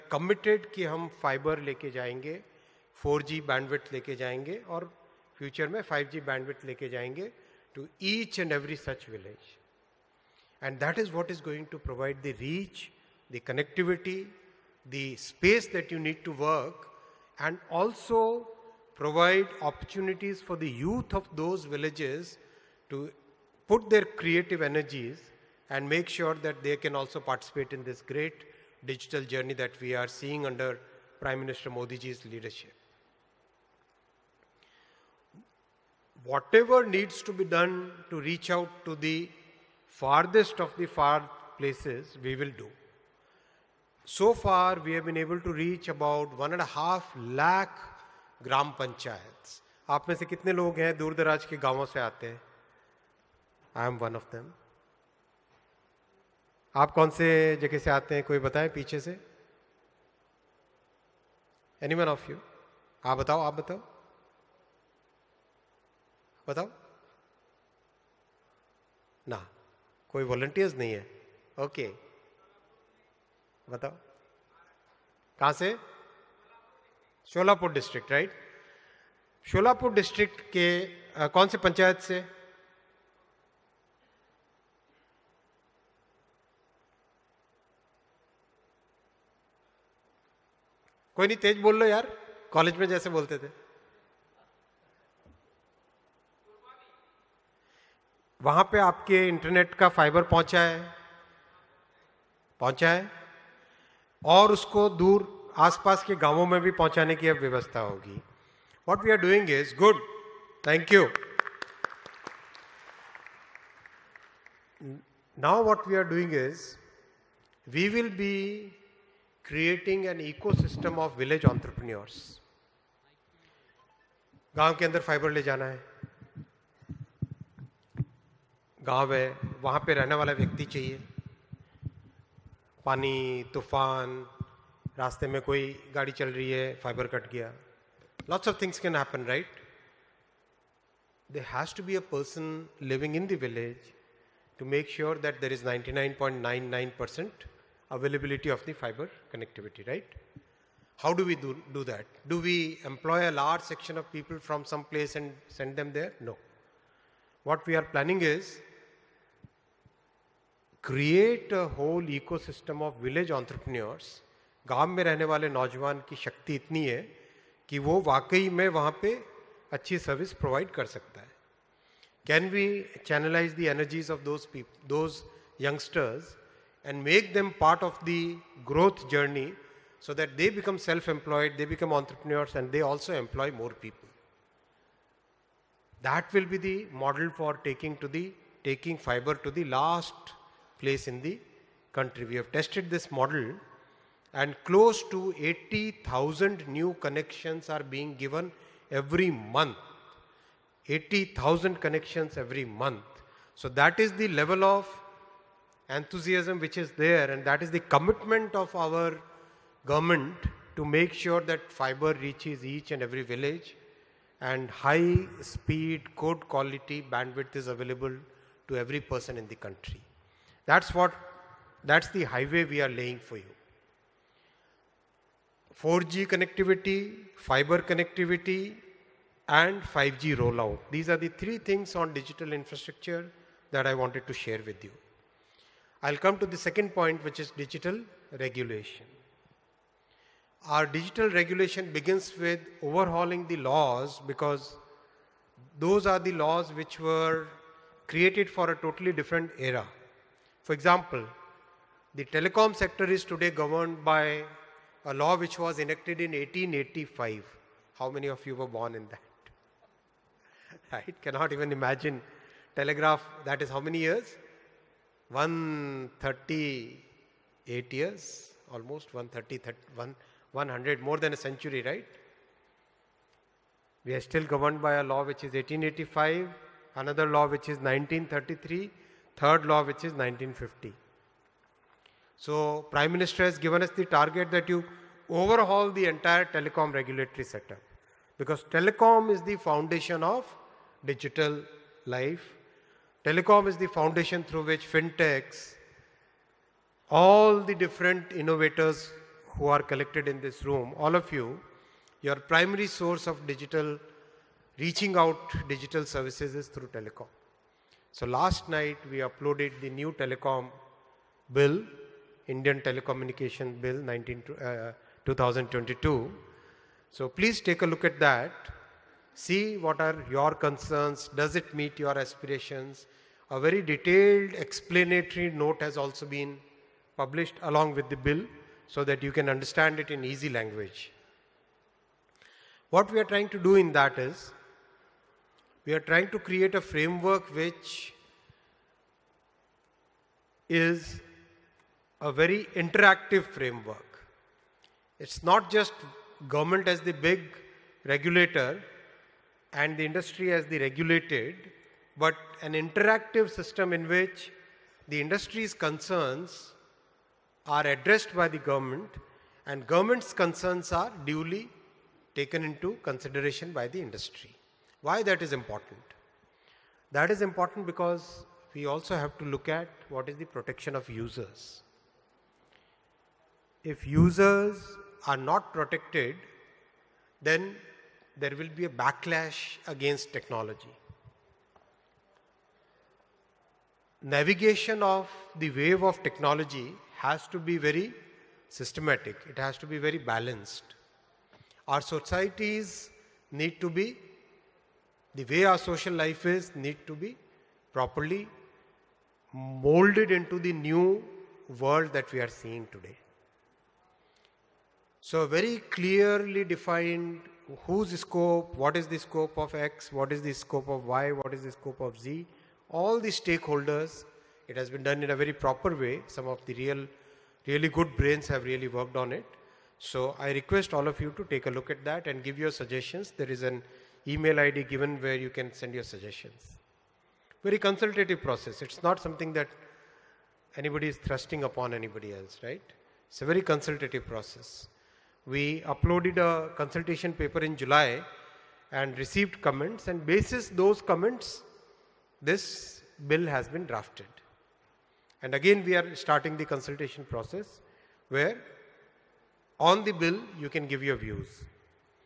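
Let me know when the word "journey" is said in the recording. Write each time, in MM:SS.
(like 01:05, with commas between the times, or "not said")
00:29, 02:59.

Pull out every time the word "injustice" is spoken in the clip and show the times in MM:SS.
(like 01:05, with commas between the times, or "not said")
not said.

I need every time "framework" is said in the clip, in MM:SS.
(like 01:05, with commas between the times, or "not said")
05:36, 05:43.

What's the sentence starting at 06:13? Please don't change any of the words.
If users are not protected, then there will be a backlash against technology.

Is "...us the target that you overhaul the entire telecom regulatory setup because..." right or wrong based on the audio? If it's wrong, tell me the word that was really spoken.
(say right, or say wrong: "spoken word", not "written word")
right.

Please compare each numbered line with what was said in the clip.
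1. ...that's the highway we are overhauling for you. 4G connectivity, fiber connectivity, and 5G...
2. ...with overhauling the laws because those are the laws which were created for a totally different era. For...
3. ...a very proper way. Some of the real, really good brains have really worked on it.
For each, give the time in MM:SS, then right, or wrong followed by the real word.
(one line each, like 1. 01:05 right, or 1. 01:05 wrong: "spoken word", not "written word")
1. 03:41 wrong: "laying", not "overhauling"
2. 04:02 right
3. 06:55 right.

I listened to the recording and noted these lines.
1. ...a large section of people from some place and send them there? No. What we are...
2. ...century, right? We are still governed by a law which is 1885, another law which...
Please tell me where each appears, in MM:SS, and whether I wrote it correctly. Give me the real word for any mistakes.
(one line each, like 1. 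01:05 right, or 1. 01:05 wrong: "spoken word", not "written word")
1. 02:33 right
2. 04:31 right.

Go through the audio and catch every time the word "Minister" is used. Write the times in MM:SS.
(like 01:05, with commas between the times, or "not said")
00:31, 04:43.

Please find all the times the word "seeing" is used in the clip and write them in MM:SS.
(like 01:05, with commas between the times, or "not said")
00:30, 06:42.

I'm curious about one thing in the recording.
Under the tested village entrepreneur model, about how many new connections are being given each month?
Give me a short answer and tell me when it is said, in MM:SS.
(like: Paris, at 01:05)
80,000, at 03:14.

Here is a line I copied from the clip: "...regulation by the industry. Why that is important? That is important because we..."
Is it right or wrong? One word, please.
wrong.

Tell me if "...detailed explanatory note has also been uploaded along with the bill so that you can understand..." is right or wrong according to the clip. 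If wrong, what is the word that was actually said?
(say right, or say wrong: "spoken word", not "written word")
wrong: "published", not "uploaded".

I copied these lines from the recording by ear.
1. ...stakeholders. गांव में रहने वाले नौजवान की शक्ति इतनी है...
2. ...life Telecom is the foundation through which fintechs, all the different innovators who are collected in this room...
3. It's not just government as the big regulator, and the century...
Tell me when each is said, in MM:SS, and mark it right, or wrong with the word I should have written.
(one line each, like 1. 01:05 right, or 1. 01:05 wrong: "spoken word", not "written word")
1. 02:43 wrong: "entrepreneurs", not "stakeholders"
2. 04:52 right
3. 05:45 wrong: "industry", not "century".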